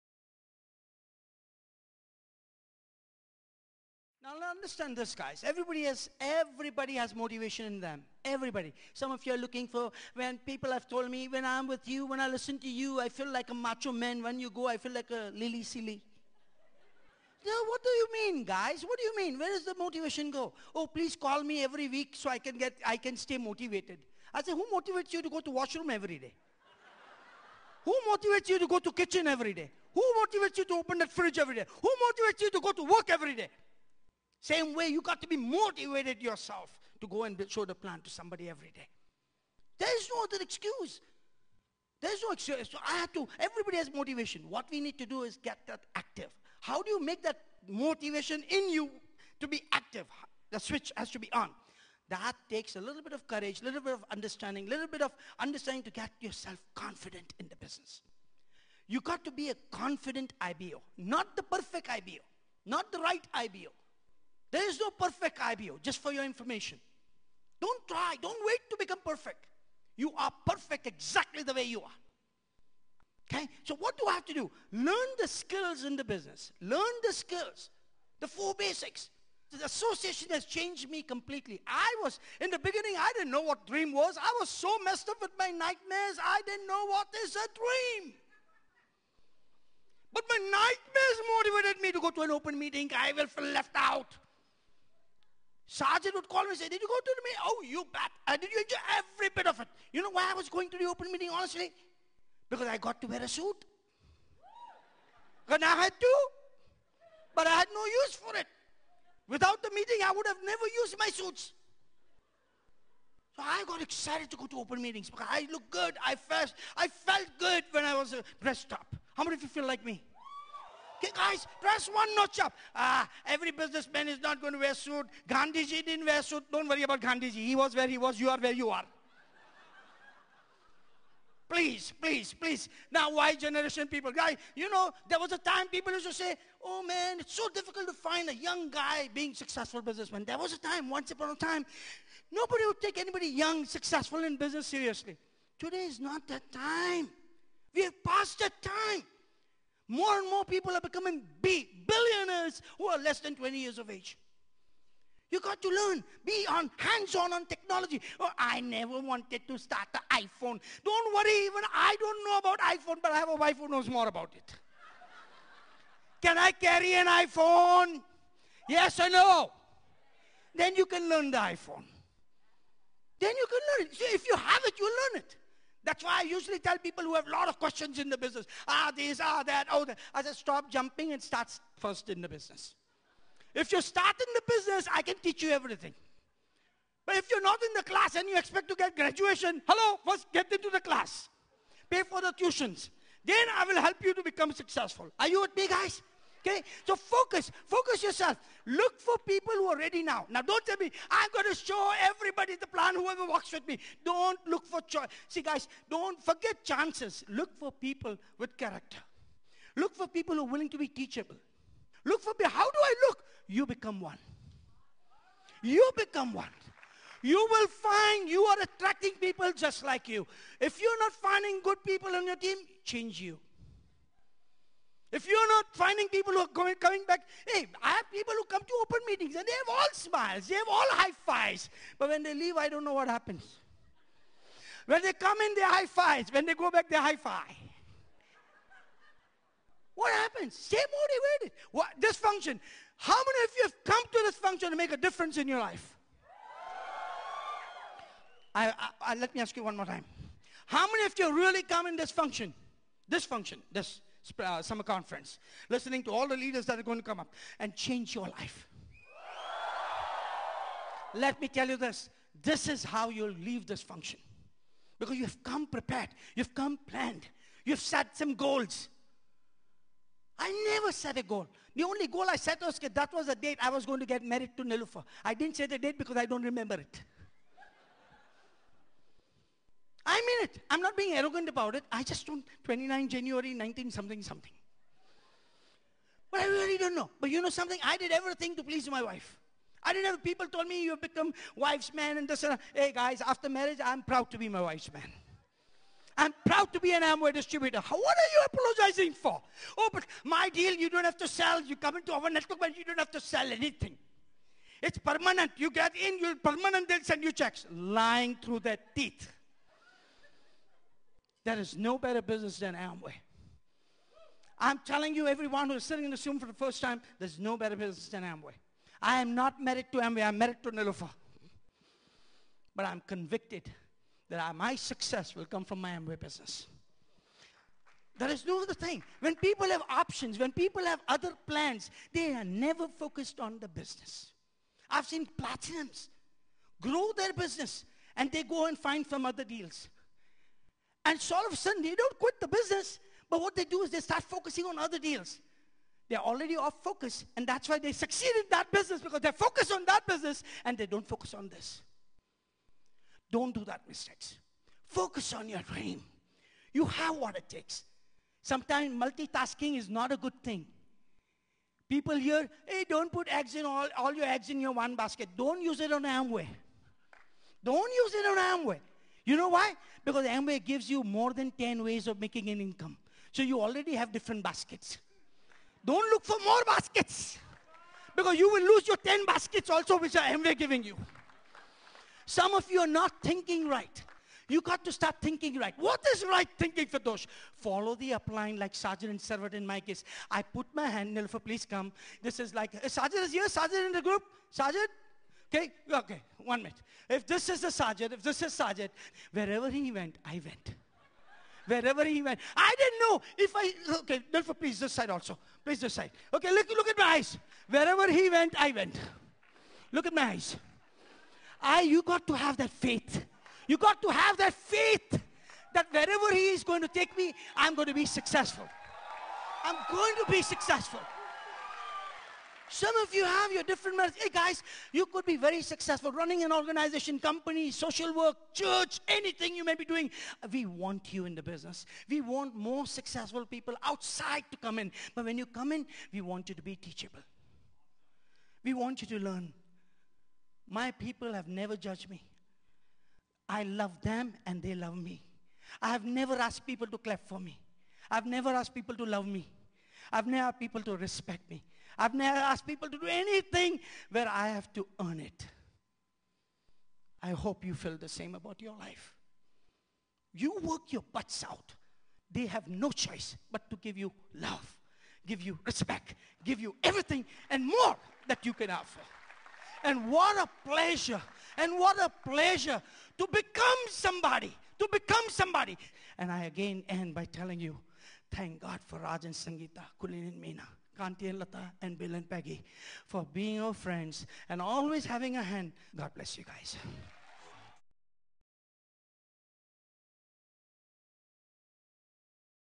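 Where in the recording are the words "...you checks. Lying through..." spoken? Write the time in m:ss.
5:07.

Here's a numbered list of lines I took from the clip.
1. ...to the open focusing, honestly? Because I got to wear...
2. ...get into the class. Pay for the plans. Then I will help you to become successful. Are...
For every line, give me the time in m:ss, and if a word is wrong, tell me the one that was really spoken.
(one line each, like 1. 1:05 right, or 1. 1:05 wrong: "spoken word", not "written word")
1. 1:40 wrong: "meeting", not "focusing"
2. 3:10 wrong: "tuitions", not "plans".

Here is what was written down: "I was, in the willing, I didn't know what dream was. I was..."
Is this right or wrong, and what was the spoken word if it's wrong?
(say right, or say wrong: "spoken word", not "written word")
wrong: "beginning", not "willing".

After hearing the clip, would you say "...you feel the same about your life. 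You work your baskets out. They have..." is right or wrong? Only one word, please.
wrong.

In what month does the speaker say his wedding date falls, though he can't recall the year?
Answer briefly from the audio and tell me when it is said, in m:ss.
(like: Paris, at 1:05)
January, at 4:43.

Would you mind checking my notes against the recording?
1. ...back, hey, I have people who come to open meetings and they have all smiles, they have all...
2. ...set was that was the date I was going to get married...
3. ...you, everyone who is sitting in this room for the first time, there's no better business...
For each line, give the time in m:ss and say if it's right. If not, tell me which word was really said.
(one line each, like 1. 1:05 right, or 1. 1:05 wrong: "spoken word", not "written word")
1. 3:47 right
2. 4:32 right
3. 5:15 right.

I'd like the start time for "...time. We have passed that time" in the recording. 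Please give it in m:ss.
2:26.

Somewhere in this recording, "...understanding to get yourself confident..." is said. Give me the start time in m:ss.
0:55.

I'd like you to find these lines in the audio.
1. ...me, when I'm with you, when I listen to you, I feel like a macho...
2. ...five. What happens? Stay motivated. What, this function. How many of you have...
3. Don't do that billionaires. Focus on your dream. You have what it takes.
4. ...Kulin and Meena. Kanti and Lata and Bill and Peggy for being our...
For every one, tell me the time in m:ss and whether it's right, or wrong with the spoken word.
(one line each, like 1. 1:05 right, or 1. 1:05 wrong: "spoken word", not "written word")
1. 0:11 right
2. 3:57 right
3. 5:53 wrong: "mistakes", not "billionaires"
4. 7:59 right.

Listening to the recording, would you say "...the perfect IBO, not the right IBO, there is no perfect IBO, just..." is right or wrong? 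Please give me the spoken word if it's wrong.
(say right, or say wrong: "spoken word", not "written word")
right.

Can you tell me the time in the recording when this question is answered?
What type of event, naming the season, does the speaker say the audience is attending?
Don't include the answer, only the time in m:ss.
4:14.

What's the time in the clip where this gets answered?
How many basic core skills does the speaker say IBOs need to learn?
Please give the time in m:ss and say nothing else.
1:18.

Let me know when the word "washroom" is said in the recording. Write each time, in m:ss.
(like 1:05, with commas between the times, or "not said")
0:25.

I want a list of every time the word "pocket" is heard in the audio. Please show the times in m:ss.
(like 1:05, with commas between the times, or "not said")
not said.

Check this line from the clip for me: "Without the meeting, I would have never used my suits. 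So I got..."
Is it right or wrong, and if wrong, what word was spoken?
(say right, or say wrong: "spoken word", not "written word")
right.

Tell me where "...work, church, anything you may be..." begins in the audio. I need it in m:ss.
7:08.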